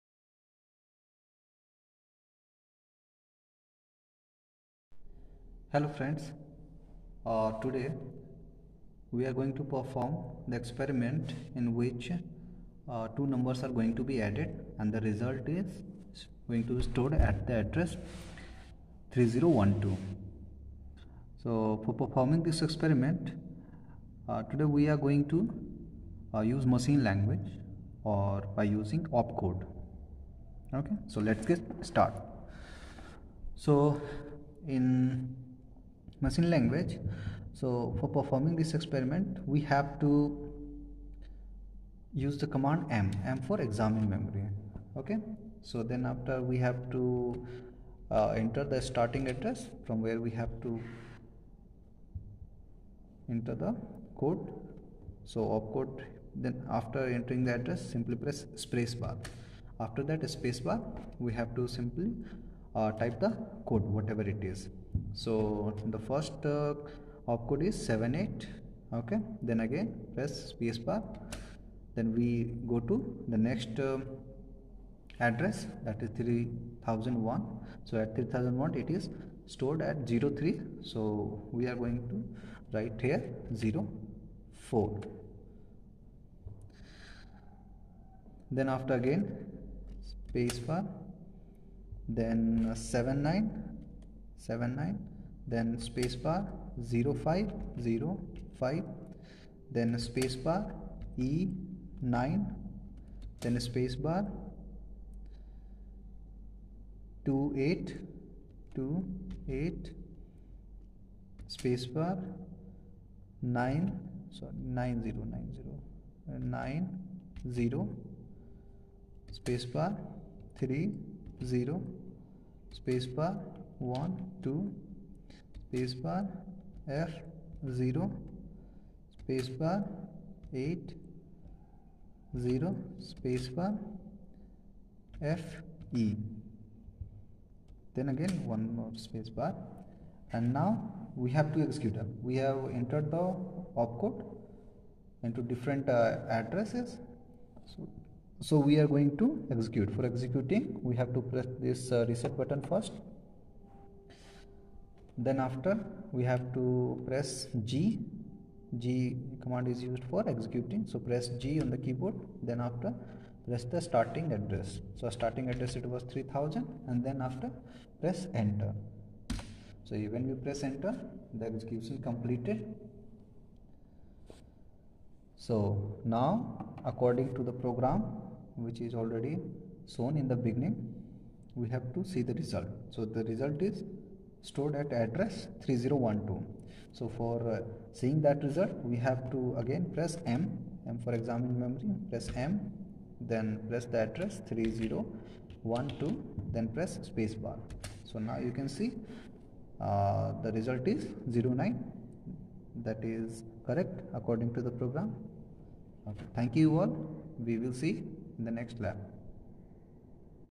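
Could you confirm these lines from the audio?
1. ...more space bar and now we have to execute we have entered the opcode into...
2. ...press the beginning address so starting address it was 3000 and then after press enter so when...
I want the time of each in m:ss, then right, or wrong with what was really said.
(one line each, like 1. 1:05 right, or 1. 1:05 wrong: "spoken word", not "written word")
1. 2:18 right
2. 2:43 wrong: "starting", not "beginning".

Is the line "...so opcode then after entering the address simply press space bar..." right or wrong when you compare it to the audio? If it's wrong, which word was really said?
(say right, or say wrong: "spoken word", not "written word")
right.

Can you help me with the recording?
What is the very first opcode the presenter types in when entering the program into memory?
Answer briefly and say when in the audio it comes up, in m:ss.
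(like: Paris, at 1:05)
78, at 1:07.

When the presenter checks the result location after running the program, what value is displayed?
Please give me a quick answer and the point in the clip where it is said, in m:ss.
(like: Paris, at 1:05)
09, at 3:21.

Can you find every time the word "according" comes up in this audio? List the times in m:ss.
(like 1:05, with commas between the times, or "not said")
2:56, 3:24.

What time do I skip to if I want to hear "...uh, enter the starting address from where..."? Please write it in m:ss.
0:48.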